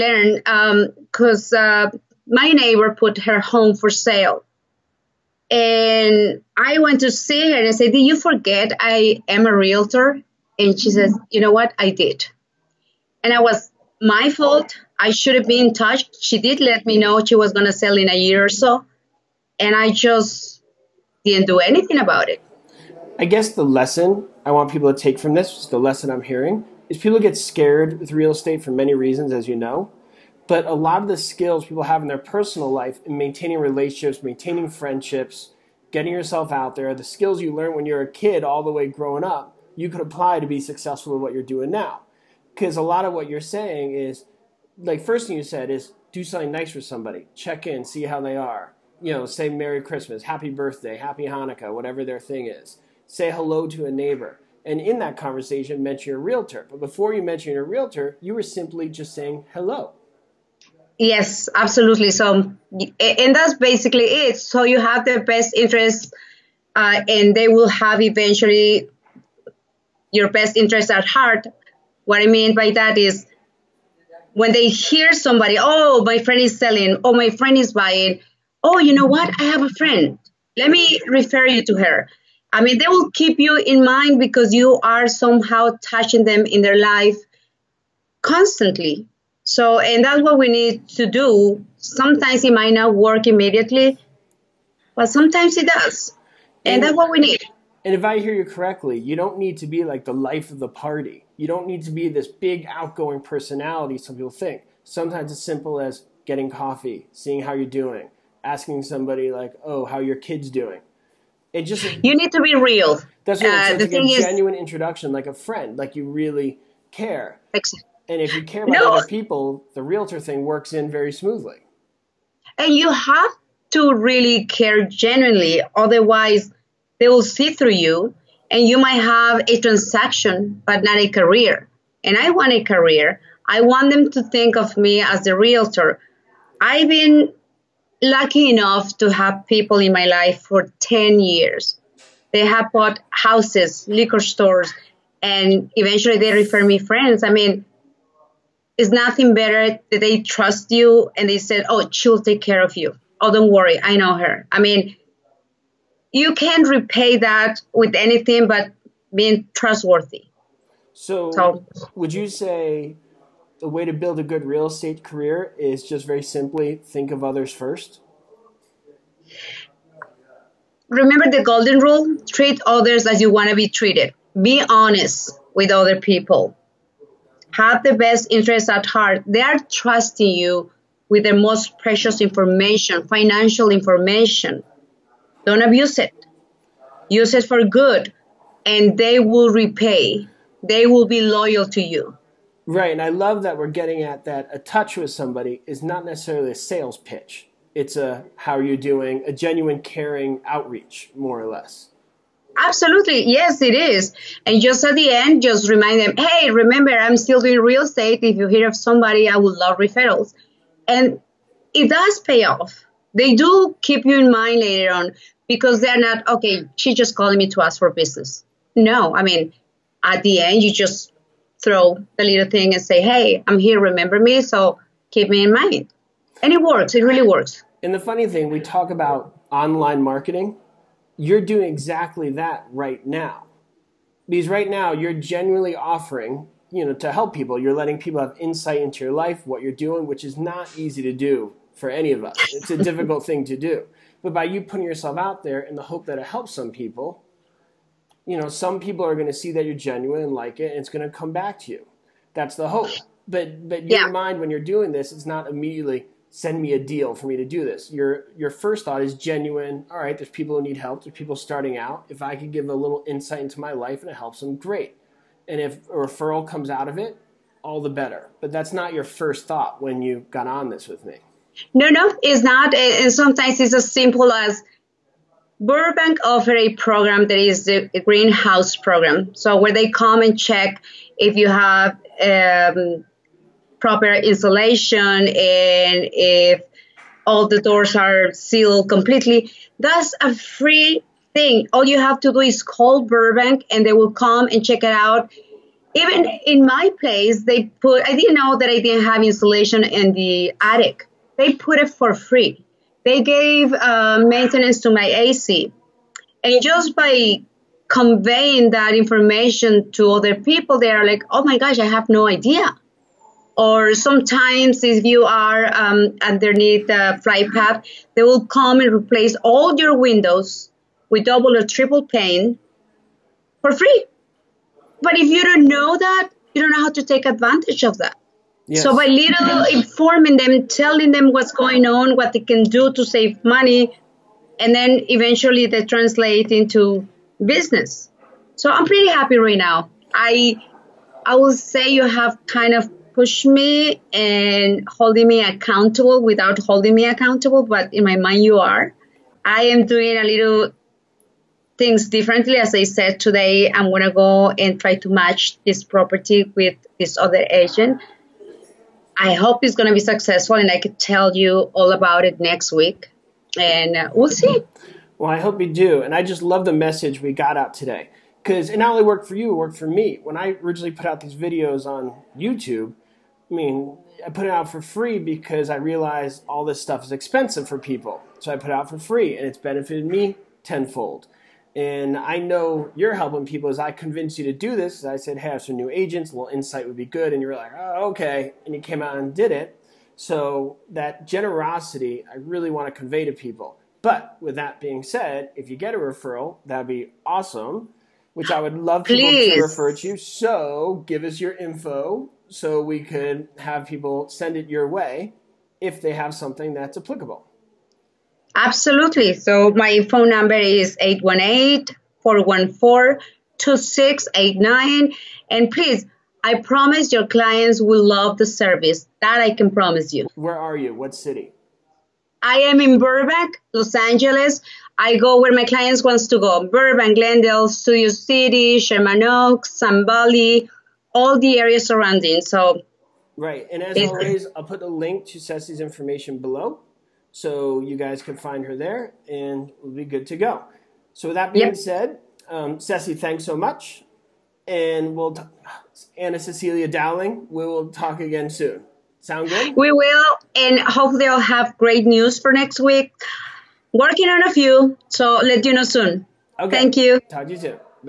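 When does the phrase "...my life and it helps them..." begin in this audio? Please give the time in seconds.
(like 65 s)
263 s.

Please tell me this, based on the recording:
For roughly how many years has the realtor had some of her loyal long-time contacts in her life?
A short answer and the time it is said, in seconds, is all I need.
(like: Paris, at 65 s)
10, at 140 s.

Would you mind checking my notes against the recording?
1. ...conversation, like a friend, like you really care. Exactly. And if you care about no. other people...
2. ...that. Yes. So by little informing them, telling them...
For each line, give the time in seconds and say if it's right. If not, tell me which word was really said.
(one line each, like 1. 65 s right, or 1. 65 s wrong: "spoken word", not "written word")
1. 114 s wrong: "introduction", not "conversation"
2. 327 s right.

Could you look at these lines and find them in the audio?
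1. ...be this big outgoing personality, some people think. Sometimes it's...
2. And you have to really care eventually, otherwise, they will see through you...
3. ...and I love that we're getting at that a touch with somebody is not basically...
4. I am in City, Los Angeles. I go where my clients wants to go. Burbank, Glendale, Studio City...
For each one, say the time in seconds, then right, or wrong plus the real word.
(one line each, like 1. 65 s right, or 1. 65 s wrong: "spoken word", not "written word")
1. 101 s right
2. 122 s wrong: "genuinely", not "eventually"
3. 192 s wrong: "necessarily", not "basically"
4. 422 s wrong: "Burbank", not "City".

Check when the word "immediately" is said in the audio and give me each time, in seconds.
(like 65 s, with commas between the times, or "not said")
93 s, 255 s.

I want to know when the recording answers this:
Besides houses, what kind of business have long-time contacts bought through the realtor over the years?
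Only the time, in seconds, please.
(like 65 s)
143 s.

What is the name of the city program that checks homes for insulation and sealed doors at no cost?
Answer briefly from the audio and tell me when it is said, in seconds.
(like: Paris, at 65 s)
greenhouse program, at 278 s.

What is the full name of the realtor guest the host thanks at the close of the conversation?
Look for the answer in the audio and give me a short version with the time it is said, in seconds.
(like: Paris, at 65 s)
Anna Cecelia Dowling, at 446 s.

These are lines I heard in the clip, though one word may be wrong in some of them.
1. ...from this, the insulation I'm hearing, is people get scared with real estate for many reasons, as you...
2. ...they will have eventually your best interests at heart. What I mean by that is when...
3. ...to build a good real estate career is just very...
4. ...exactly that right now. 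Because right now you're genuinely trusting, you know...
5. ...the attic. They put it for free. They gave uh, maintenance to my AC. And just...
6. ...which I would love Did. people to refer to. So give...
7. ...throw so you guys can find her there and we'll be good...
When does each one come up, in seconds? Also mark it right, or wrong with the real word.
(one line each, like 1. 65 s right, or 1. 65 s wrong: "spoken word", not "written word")
1. 25 s wrong: "lesson", not "insulation"
2. 67 s right
3. 163 s right
4. 231 s wrong: "offering", not "trusting"
5. 300 s right
6. 398 s wrong: "Please", not "Did"
7. 436 s wrong: "below", not "throw".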